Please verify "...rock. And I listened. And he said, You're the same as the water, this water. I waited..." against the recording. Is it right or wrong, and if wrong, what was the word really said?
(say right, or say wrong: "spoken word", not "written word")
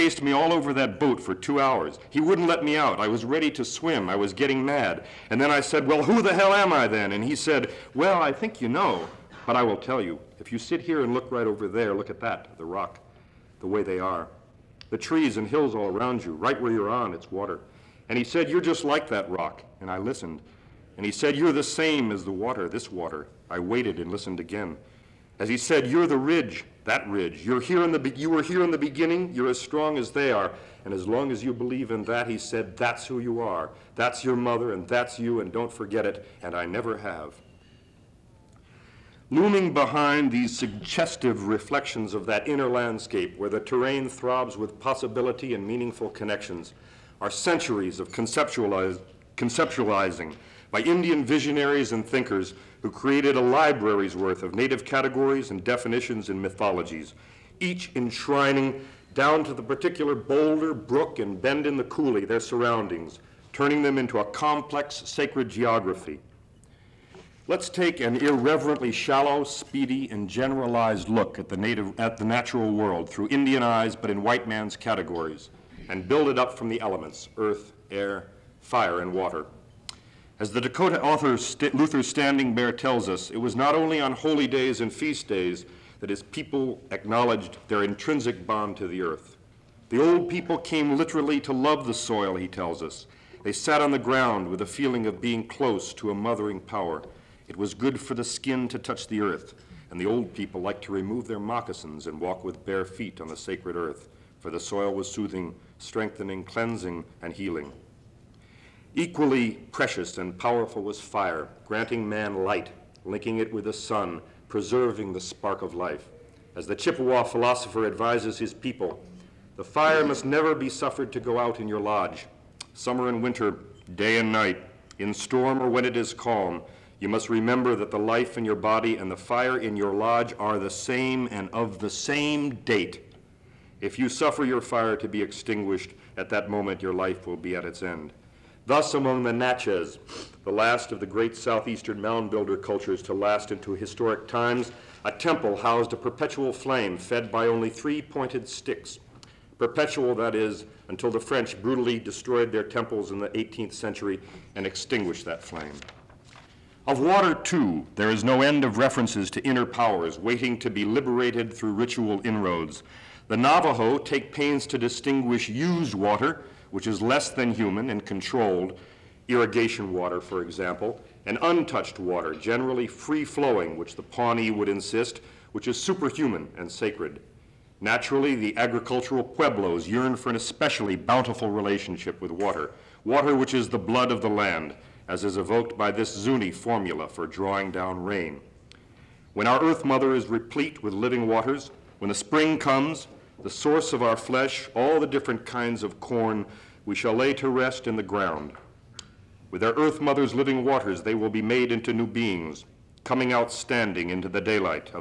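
right.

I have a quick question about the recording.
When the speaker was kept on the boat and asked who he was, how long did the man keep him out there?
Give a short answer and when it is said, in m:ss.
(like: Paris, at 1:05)
2 hours, at 0:01.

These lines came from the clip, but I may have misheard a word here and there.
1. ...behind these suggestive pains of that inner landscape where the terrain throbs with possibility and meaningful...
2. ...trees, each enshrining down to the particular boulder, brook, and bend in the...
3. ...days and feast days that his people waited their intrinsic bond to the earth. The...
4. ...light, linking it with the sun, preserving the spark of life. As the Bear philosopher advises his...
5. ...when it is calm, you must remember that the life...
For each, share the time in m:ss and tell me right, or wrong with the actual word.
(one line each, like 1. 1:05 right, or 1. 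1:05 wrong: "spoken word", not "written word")
1. 0:39 wrong: "reflections", not "pains"
2. 0:56 wrong: "mythologies", not "trees"
3. 1:24 wrong: "acknowledged", not "waited"
4. 1:52 wrong: "Chippewa", not "Bear"
5. 2:05 right.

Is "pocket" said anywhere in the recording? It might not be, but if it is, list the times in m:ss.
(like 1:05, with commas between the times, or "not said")
not said.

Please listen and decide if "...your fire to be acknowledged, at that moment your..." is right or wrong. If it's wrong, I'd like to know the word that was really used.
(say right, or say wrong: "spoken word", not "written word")
wrong: "extinguished", not "acknowledged".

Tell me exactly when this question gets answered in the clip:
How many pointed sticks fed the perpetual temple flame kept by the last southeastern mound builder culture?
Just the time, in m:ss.
2:27.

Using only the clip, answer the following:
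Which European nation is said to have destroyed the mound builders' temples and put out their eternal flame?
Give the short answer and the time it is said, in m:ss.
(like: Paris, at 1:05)
French, at 2:31.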